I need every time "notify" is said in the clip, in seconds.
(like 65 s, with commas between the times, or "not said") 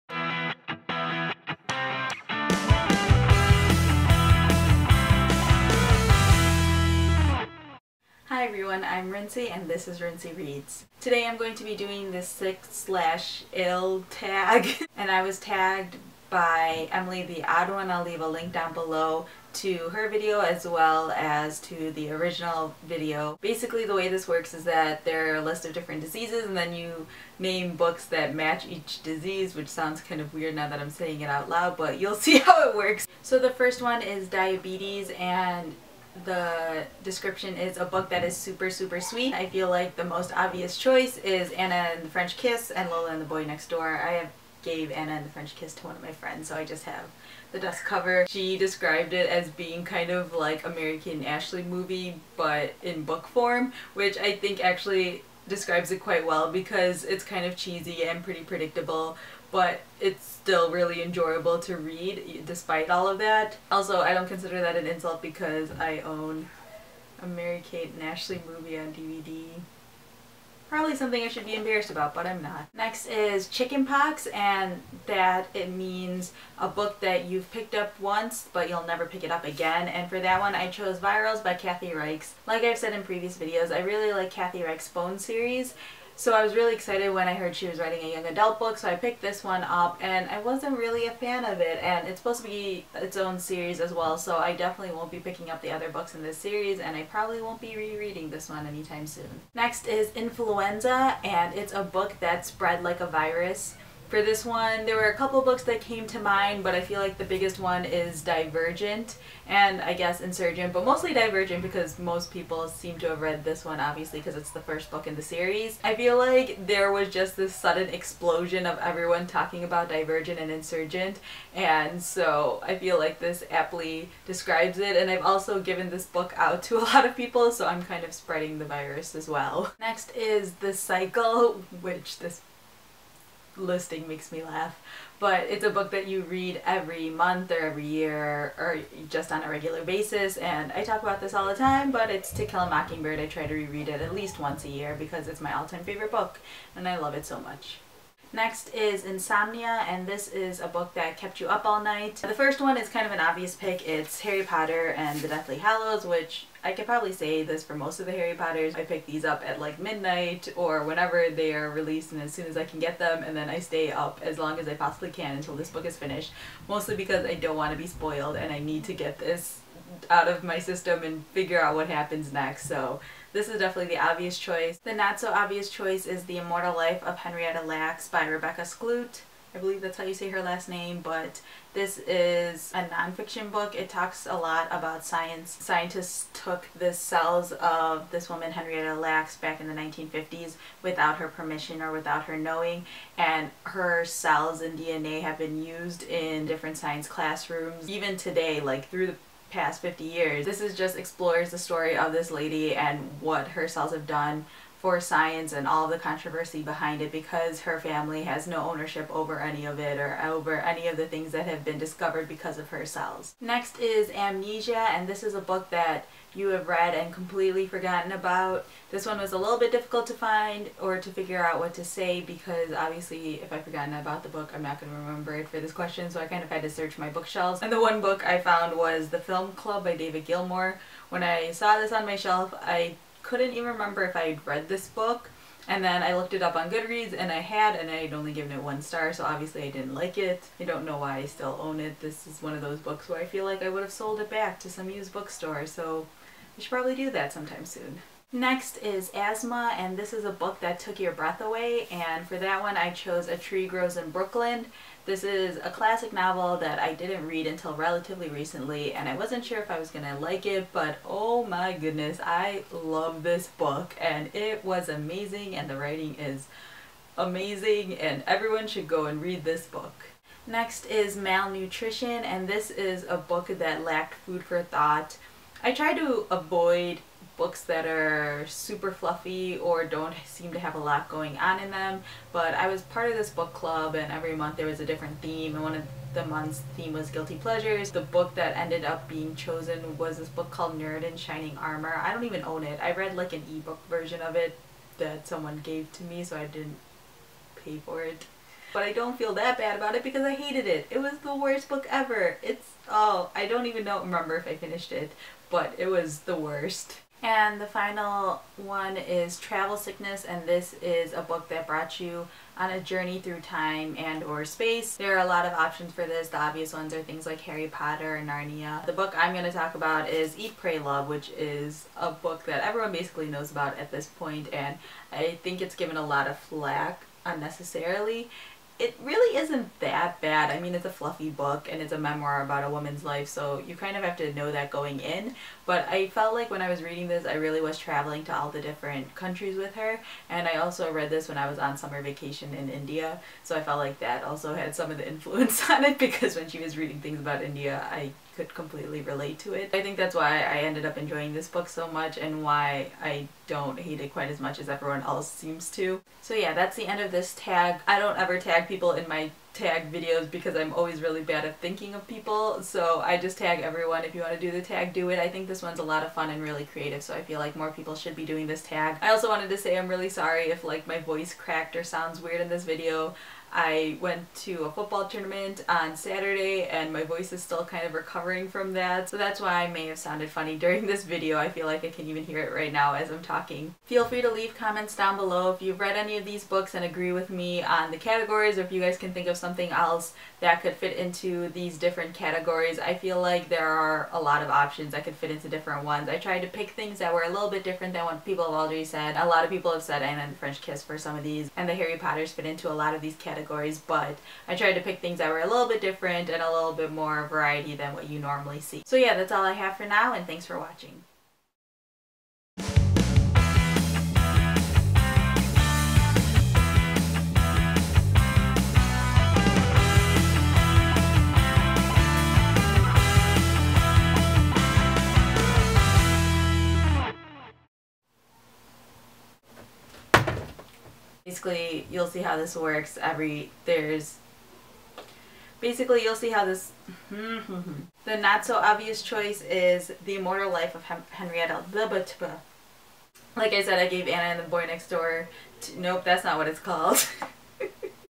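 not said.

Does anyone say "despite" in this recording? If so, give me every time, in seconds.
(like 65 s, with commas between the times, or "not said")
62 s.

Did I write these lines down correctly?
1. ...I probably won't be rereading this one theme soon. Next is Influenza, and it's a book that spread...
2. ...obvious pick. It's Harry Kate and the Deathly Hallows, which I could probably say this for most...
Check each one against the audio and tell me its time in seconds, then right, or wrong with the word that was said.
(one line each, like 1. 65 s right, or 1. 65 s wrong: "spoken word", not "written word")
1. 96 s wrong: "anytime", not "theme"
2. 153 s wrong: "Potter", not "Kate".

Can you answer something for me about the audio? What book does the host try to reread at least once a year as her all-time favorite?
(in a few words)
To Kill a Mockingbird.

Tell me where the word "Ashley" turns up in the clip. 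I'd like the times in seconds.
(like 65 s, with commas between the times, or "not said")
51 s, 68 s.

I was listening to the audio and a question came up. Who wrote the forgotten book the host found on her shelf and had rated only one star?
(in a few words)
David Gilmour.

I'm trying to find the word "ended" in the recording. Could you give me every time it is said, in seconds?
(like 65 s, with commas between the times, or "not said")
288 s, 350 s.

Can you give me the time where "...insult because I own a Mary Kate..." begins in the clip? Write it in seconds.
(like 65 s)
64 s.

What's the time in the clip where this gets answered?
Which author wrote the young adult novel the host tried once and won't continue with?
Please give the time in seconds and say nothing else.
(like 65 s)
81 s.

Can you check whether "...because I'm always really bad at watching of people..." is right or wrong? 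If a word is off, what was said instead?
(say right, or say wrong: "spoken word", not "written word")
wrong: "thinking", not "watching".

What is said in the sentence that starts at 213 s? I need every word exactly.
Next is Amnesia and this is a book that you have read and completely forgotten about.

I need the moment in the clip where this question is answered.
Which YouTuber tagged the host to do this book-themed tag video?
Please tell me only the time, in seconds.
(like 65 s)
16 s.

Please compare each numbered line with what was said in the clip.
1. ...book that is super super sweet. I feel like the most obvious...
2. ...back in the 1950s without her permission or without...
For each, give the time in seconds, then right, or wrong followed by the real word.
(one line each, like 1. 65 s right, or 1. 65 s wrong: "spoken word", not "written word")
1. 37 s right
2. 189 s right.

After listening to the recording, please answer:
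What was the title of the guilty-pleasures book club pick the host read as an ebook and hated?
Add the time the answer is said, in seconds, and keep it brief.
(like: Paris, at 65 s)
Nerd in Shining Armor, at 290 s.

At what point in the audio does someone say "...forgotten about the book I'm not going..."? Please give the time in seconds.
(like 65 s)
223 s.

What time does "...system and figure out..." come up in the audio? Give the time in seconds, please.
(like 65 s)
170 s.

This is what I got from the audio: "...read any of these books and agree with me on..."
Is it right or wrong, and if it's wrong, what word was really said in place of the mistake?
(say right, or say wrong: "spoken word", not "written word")
right.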